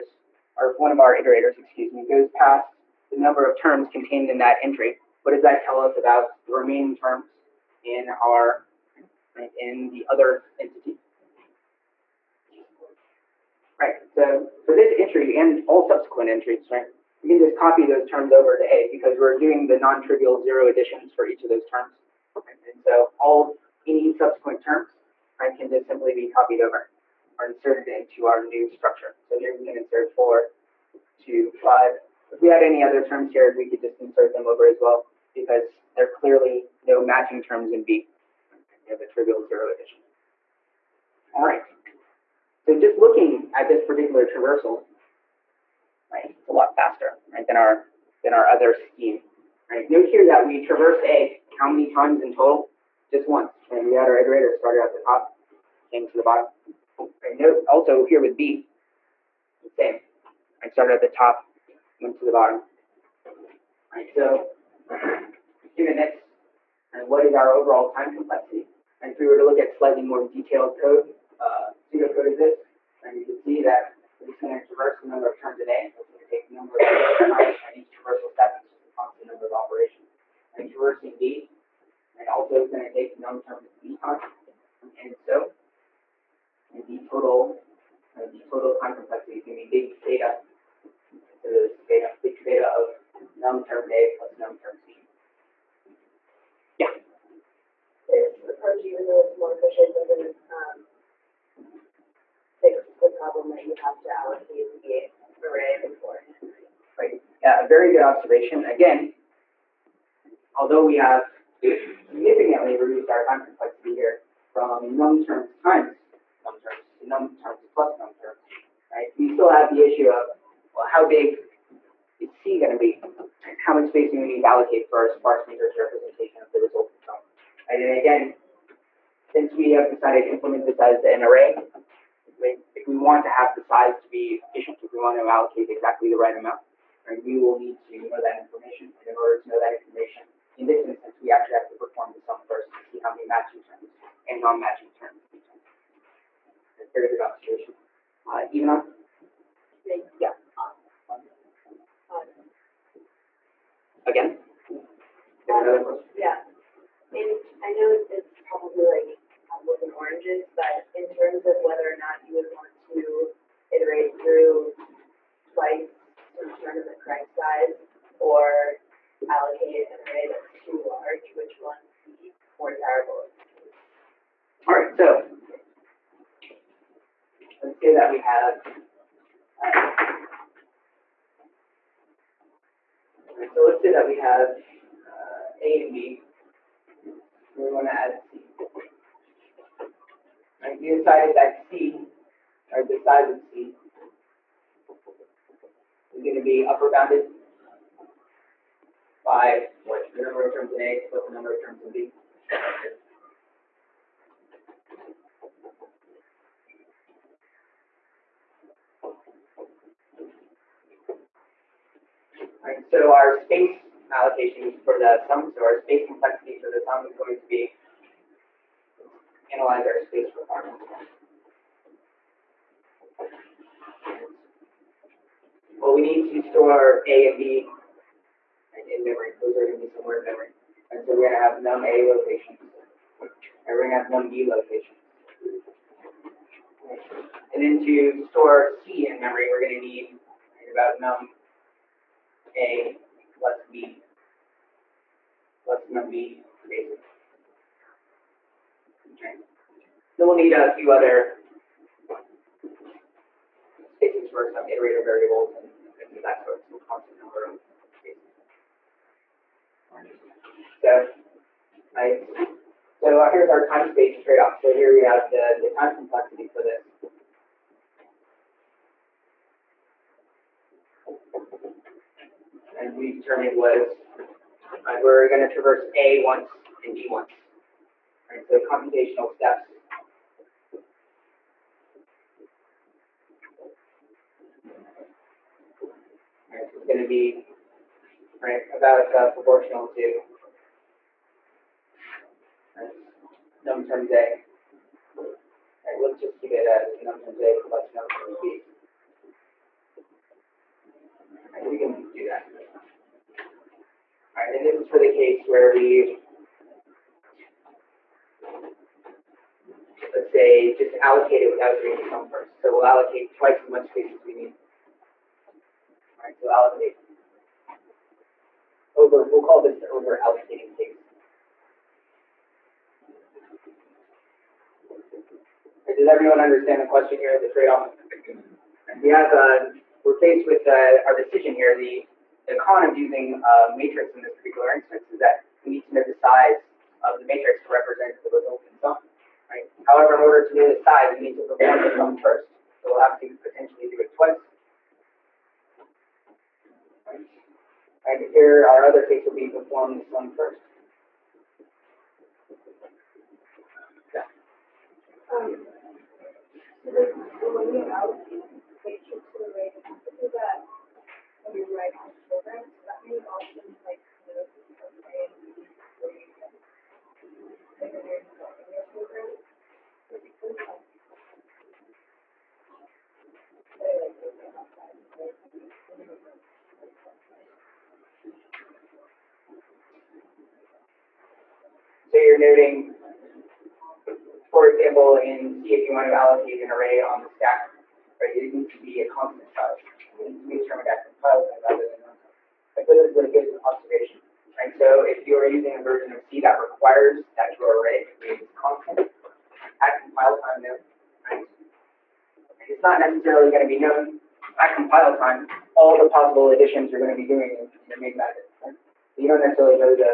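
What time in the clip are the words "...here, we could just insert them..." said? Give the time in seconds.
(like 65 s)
33 s.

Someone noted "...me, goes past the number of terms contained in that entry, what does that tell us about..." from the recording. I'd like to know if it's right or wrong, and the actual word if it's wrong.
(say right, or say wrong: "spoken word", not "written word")
right.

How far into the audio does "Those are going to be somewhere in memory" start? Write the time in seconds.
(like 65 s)
229 s.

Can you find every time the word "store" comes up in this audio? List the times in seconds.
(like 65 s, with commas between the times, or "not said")
226 s, 238 s.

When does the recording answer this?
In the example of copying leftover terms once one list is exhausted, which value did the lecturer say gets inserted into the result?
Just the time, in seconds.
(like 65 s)
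29 s.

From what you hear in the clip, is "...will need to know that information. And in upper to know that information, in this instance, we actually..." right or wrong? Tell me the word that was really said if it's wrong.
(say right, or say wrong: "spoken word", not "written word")
wrong: "order", not "upper".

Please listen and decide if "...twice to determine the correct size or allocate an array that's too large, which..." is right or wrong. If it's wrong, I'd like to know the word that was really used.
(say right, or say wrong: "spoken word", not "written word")
right.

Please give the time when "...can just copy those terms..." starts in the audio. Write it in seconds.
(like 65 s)
17 s.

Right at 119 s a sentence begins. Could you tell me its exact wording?
We still have the issue of well, how big is C going to be?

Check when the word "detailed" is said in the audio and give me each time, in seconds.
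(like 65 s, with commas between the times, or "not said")
70 s.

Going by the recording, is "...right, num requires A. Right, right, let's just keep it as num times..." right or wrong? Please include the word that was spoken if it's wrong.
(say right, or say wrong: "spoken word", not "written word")
wrong: "times", not "requires".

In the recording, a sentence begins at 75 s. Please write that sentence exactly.
That's going to take the number of times time, and each traversal step is just a constant number of operations.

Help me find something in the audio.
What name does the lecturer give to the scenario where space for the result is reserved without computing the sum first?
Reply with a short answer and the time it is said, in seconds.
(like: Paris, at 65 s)
over allocating case, at 319 s.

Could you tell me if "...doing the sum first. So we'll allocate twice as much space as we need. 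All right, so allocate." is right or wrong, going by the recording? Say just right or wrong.
right.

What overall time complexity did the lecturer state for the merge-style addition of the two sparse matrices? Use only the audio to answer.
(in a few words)
big theta of num terms A plus num terms B.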